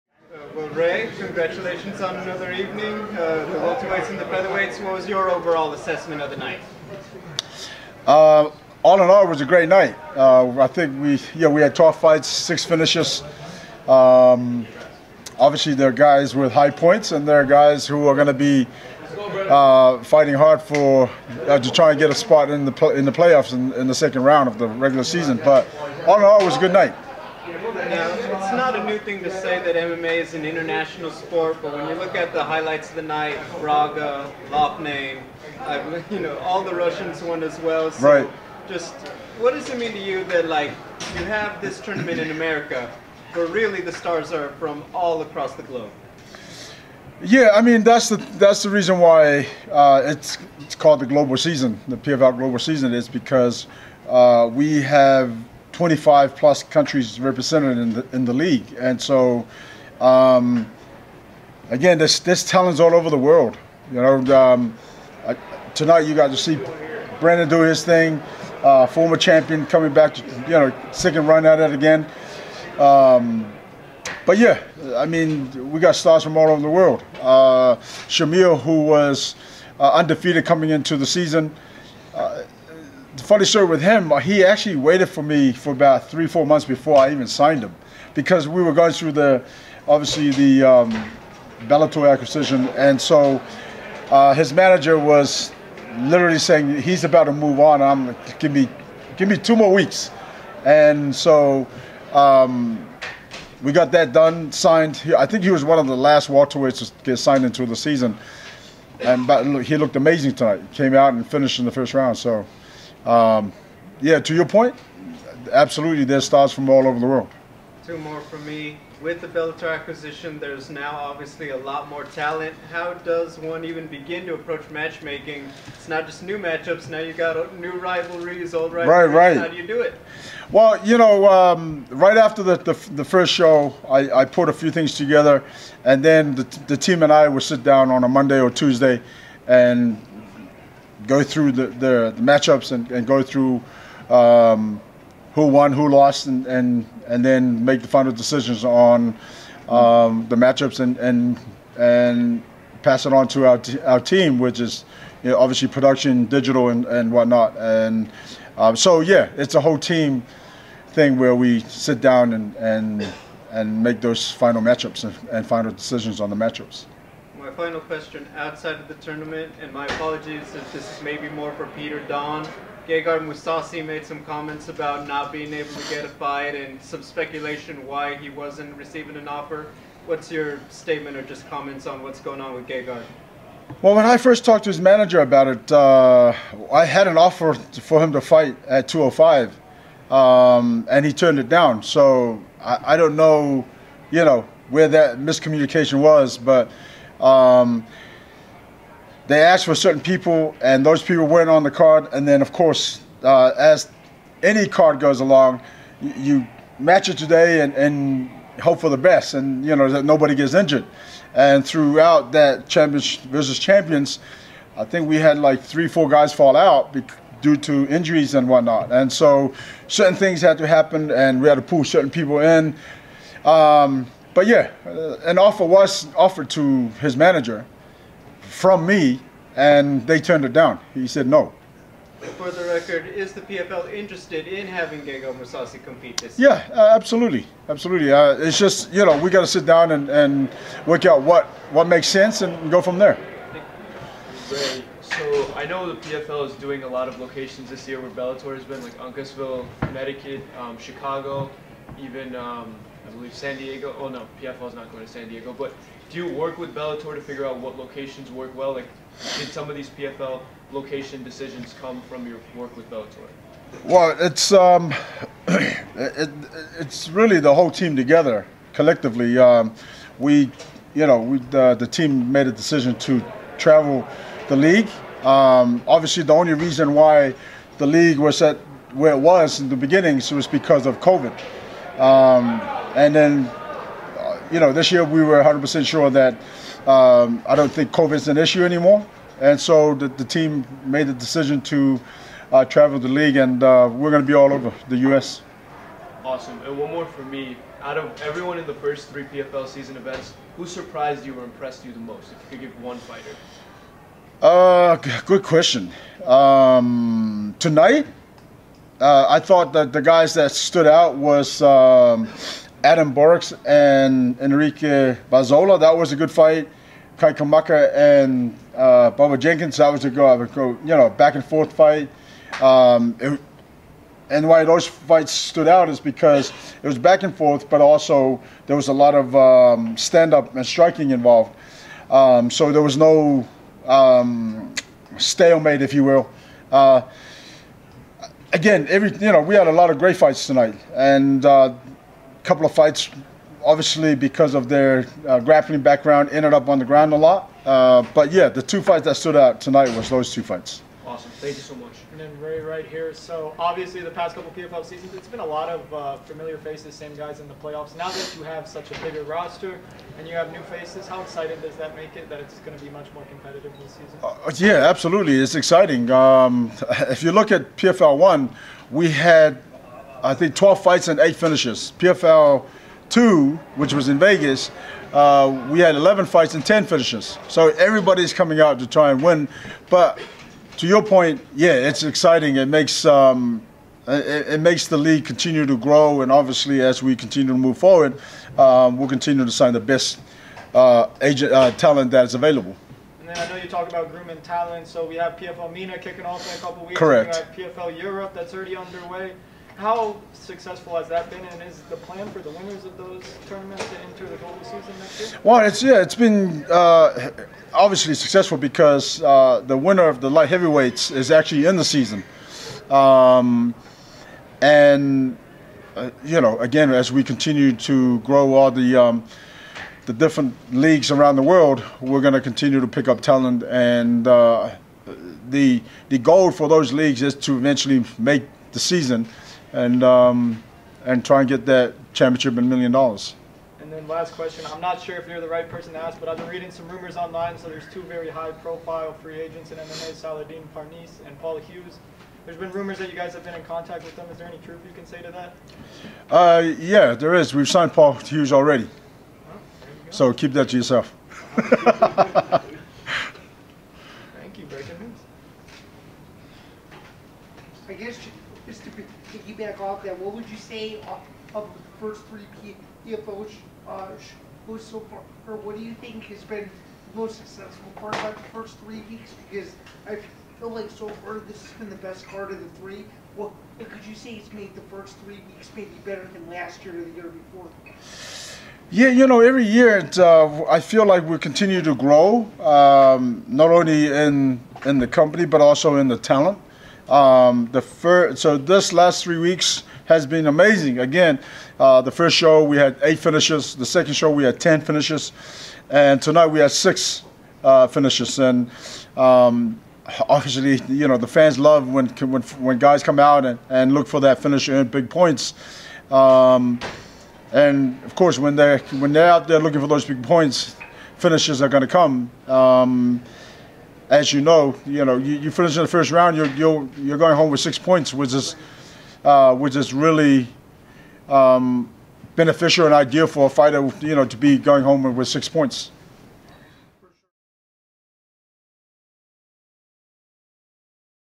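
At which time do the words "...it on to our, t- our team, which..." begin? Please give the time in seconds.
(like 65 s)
153 s.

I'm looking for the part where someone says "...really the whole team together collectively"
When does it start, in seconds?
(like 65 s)
267 s.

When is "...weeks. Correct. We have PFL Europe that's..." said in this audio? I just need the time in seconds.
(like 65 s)
396 s.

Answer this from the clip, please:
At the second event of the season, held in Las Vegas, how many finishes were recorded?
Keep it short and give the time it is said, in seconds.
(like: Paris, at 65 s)
10, at 376 s.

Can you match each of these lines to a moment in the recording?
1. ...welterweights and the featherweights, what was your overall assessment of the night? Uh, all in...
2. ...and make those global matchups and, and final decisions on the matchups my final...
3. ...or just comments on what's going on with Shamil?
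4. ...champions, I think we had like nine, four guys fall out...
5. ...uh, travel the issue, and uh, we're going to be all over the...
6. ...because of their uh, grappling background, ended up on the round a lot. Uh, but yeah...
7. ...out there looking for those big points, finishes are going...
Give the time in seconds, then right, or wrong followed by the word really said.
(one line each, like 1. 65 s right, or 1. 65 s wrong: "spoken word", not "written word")
1. 3 s right
2. 163 s wrong: "final", not "global"
3. 181 s wrong: "Gegard", not "Shamil"
4. 213 s wrong: "three", not "nine"
5. 292 s wrong: "league", not "issue"
6. 344 s wrong: "ground", not "round"
7. 509 s right.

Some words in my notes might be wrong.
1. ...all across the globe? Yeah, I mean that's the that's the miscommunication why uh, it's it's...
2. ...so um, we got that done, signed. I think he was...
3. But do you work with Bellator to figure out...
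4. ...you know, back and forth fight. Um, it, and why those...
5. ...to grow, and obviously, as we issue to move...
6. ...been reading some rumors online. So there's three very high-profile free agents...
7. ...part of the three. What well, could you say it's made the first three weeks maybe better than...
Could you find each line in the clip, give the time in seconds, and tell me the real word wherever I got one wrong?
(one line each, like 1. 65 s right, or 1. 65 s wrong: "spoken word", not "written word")
1. 44 s wrong: "reason", not "miscommunication"
2. 101 s right
3. 255 s right
4. 320 s right
5. 385 s wrong: "continue", not "issue"
6. 436 s wrong: "two", not "three"
7. 472 s right.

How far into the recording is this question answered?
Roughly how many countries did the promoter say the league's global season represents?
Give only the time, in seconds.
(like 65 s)
55 s.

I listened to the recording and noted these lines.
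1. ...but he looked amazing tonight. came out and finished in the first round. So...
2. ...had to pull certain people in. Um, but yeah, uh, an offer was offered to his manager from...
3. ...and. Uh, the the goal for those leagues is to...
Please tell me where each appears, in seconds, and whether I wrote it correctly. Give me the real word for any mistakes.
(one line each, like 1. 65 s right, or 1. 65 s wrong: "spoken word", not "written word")
1. 109 s right
2. 221 s right
3. 423 s right.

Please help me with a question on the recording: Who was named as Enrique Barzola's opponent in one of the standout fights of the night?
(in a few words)
Adam Borics.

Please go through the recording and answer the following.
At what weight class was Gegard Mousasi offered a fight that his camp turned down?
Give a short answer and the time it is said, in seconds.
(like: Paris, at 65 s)
205, at 188 s.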